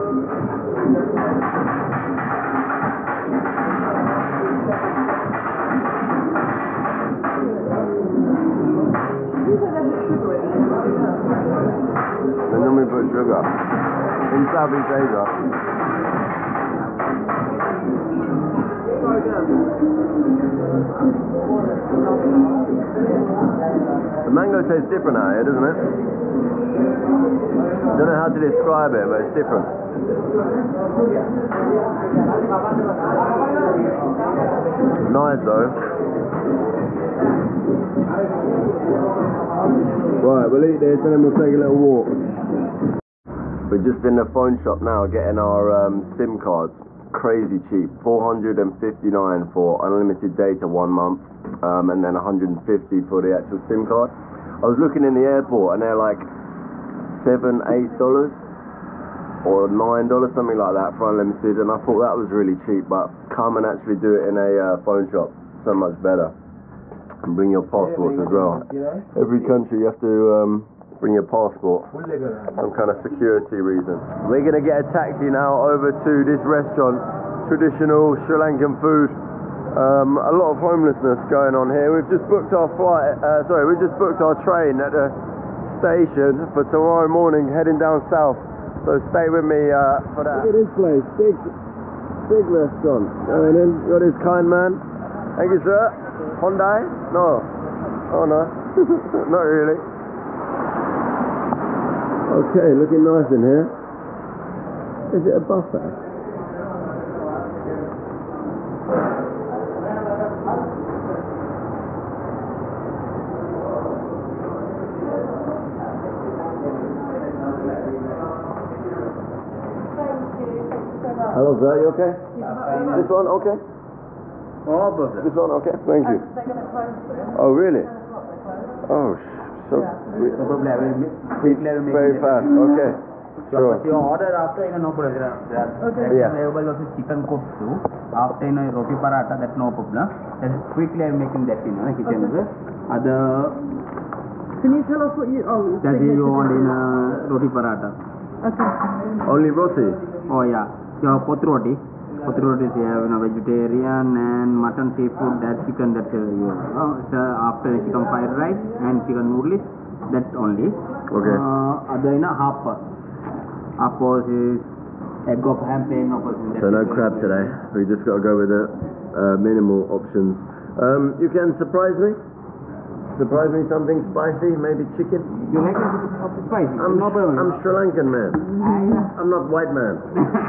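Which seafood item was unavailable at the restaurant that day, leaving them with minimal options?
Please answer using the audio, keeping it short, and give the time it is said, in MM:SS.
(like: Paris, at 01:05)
Crab, at 02:46.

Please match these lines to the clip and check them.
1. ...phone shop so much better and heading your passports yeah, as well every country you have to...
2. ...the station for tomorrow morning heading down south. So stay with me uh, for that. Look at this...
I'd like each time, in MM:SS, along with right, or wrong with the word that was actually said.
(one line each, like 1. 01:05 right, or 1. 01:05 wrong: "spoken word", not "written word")
1. 01:04 wrong: "bring", not "heading"
2. 01:24 right.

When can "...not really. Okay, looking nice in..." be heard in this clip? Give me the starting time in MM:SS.
01:39.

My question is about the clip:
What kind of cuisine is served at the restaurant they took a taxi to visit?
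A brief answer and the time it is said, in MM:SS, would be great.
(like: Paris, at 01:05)
Traditional Sri Lankan food, at 01:17.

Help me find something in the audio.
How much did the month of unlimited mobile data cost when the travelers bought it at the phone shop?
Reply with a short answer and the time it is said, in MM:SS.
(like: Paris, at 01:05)
459, at 00:48.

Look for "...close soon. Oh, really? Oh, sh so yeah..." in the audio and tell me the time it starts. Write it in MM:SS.
02:06.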